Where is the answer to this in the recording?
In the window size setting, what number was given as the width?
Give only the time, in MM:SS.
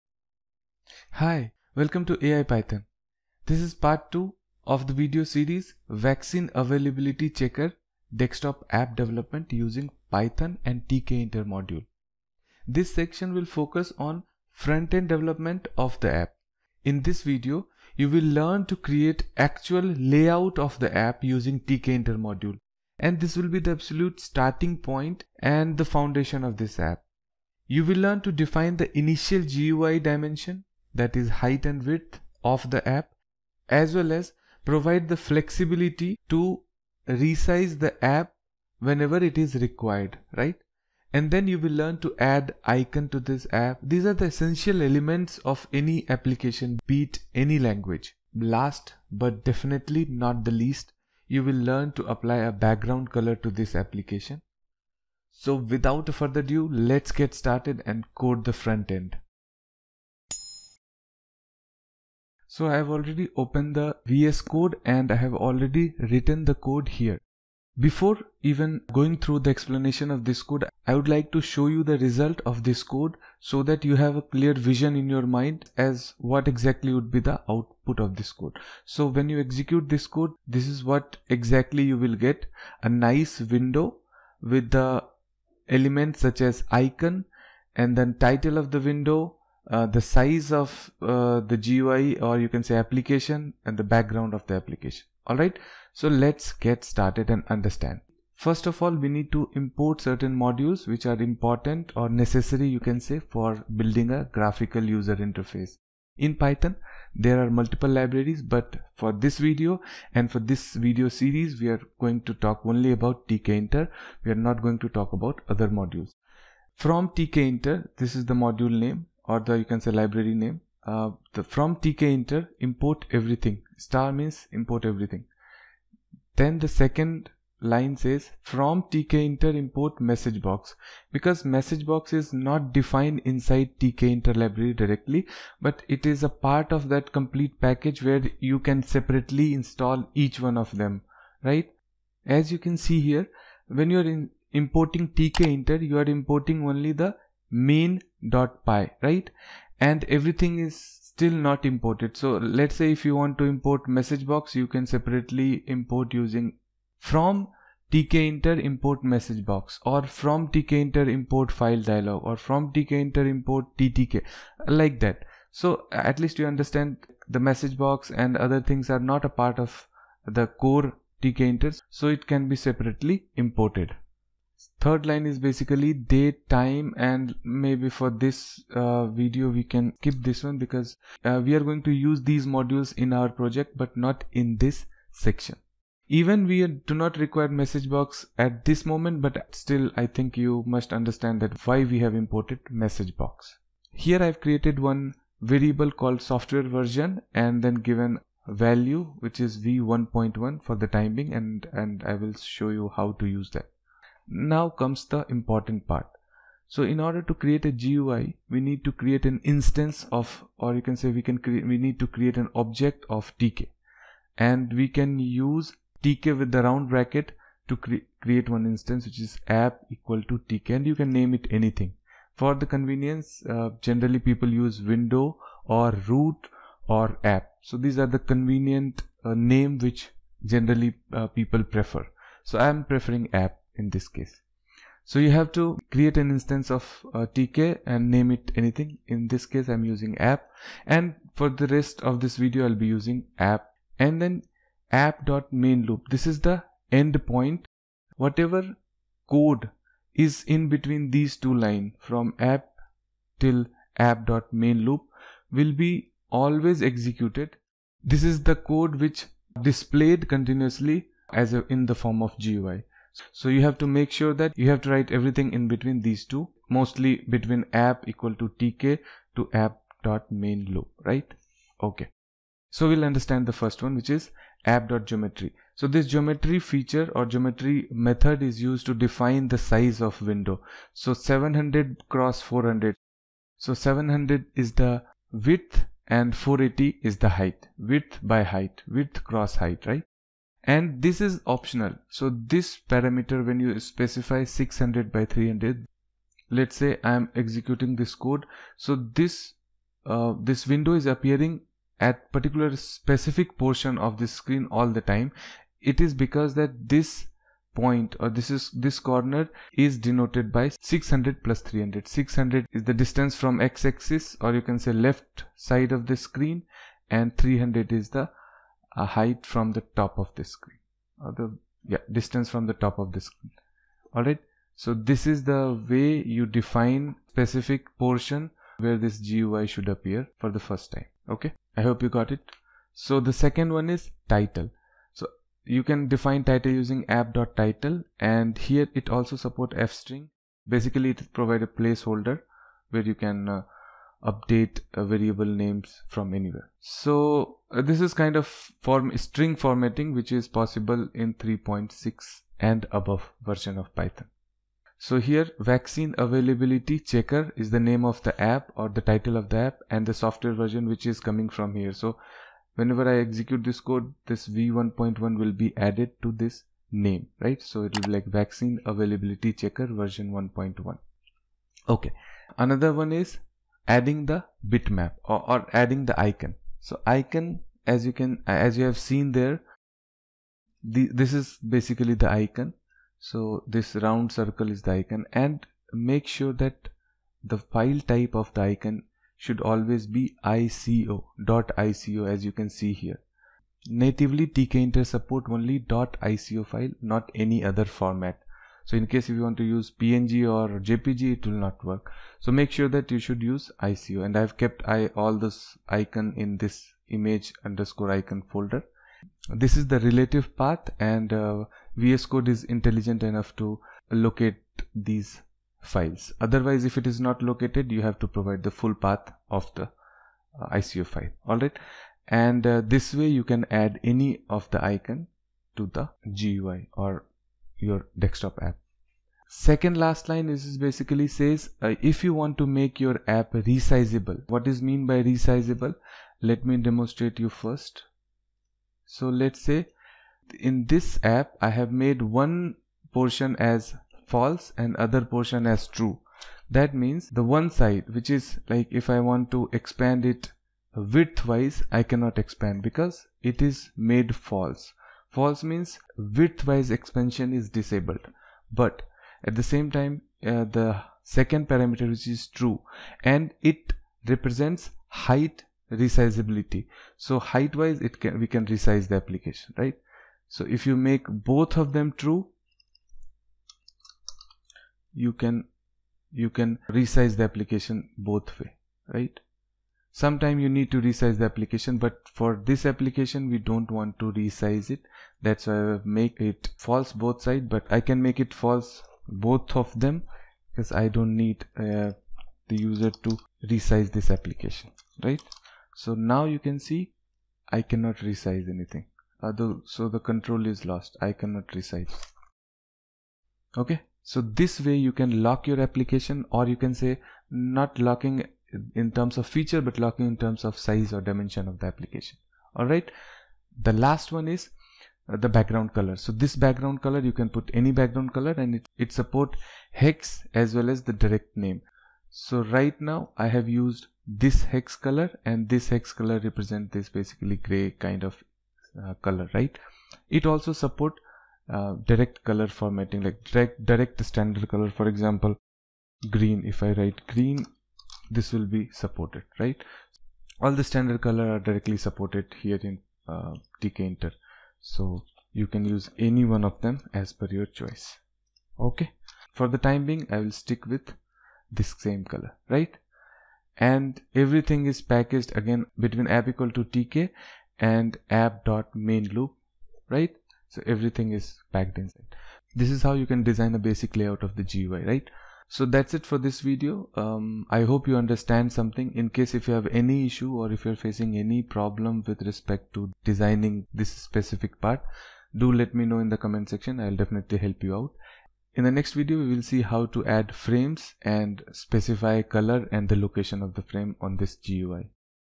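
04:43.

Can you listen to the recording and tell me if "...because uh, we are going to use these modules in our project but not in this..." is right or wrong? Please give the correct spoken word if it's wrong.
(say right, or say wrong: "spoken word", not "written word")
right.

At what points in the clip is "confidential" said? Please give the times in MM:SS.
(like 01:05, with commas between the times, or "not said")
not said.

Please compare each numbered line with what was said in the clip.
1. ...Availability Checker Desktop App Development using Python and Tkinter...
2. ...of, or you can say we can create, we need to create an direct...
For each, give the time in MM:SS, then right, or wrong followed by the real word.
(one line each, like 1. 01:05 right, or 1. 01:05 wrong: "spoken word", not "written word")
1. 00:06 right
2. 03:30 wrong: "object", not "direct".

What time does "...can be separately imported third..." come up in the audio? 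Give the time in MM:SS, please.
02:52.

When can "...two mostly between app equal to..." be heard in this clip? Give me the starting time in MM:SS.
04:26.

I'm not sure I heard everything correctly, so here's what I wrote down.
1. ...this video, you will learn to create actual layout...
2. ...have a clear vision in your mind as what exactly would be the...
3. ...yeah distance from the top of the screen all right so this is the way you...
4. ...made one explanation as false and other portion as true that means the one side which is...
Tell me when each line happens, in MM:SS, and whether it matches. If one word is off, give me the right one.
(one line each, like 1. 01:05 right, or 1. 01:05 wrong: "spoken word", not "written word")
1. 00:17 right
2. 01:14 right
3. 05:21 right
4. 07:21 wrong: "portion", not "explanation".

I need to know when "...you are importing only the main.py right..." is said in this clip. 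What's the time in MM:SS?
02:25.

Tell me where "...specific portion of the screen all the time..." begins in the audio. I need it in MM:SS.
05:02.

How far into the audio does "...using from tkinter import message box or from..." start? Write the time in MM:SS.
02:36.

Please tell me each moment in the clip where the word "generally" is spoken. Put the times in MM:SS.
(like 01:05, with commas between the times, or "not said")
03:43, 03:50.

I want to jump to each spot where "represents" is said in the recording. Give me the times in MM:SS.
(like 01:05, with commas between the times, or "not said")
07:44, 08:46.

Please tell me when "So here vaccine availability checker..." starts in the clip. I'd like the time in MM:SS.
05:54.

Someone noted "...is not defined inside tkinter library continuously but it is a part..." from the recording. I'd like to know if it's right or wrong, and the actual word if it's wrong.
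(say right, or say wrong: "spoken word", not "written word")
wrong: "directly", not "continuously".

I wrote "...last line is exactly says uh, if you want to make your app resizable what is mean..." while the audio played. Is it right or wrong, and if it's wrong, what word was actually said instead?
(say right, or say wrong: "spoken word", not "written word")
wrong: "basically", not "exactly".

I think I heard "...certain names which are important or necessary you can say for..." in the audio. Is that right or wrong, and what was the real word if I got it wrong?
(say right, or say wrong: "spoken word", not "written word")
wrong: "modules", not "names".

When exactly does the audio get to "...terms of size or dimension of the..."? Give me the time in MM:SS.
08:30.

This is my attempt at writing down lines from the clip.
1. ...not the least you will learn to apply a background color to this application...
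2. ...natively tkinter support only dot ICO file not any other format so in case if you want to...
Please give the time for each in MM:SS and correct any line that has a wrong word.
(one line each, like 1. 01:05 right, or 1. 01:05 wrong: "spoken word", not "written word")
1. 00:50 right
2. 06:33 right.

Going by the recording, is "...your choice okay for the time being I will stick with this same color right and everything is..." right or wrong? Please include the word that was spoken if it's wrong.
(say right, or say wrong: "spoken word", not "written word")
right.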